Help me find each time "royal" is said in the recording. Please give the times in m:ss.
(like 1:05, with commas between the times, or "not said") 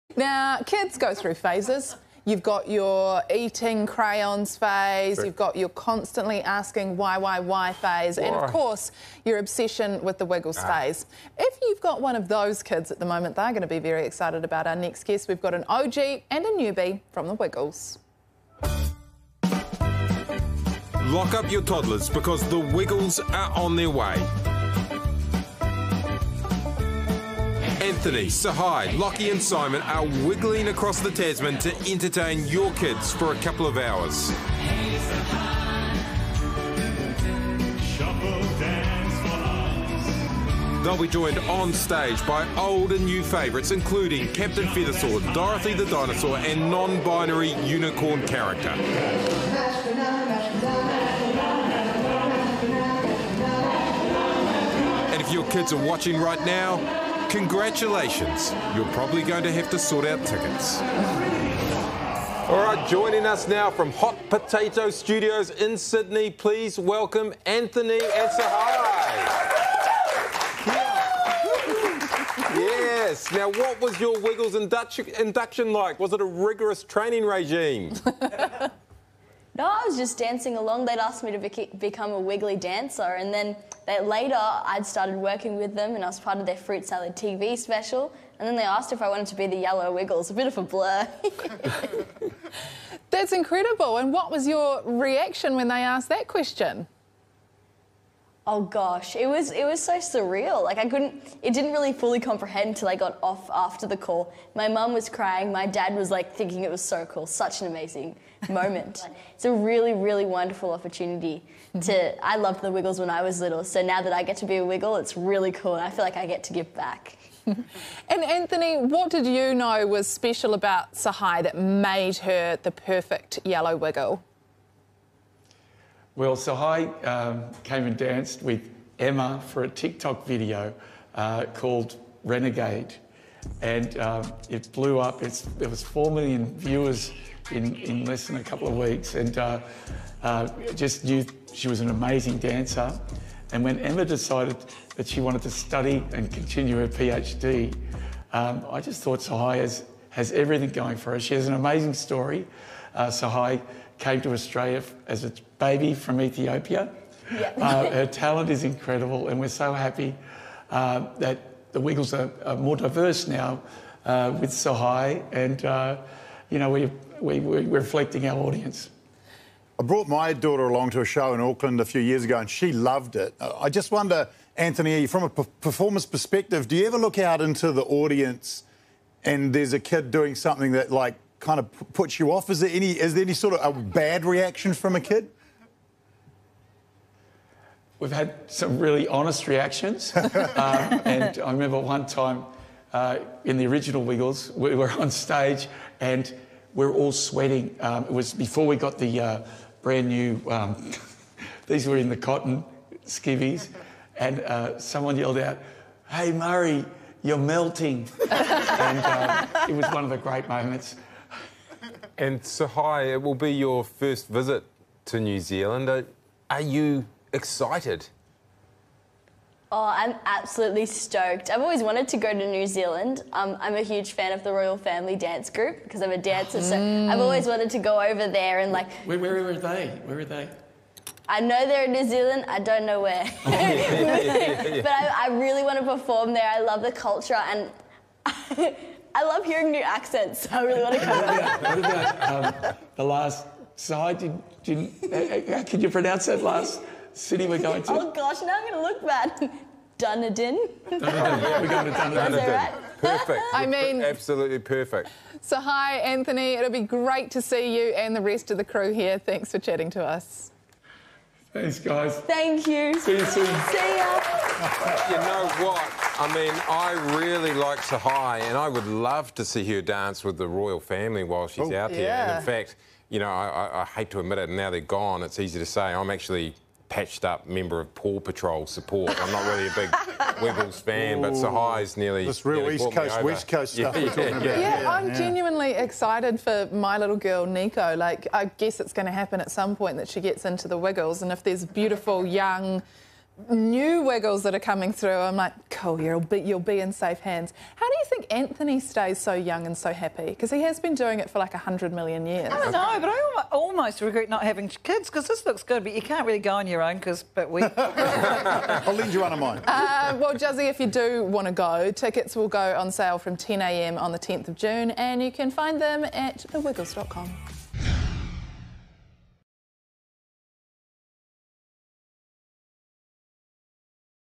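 3:44, 4:30.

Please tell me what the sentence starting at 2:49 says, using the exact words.
I brought my daughter along to a show in Auckland a few years ago, and she loved it.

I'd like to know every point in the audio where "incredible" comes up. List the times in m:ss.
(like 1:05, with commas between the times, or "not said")
1:33, 2:38.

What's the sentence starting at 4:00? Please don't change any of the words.
So I really want to come back.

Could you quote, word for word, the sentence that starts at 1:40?
Like I couldn't, it didn't really fully comprehend until I got off after the call.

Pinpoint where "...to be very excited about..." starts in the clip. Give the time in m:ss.
0:13.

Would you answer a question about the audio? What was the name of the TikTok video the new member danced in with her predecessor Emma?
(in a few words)
Renegade.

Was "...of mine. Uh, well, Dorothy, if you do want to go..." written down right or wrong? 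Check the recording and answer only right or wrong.
wrong.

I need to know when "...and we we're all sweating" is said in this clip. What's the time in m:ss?
3:15.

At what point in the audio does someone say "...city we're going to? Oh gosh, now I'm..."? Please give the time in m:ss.
4:07.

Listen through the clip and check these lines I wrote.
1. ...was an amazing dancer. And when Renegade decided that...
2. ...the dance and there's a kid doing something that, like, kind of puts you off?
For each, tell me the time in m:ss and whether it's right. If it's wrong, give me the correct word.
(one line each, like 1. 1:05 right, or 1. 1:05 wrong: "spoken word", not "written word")
1. 2:21 wrong: "Emma", not "Renegade"
2. 2:57 wrong: "audience", not "dance".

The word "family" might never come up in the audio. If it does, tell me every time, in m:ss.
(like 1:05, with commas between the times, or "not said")
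3:44, 4:30.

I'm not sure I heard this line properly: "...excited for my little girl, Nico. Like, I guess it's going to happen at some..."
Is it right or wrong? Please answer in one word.
right.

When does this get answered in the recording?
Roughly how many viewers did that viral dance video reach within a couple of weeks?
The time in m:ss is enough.
2:15.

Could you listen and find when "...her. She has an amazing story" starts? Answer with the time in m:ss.
2:31.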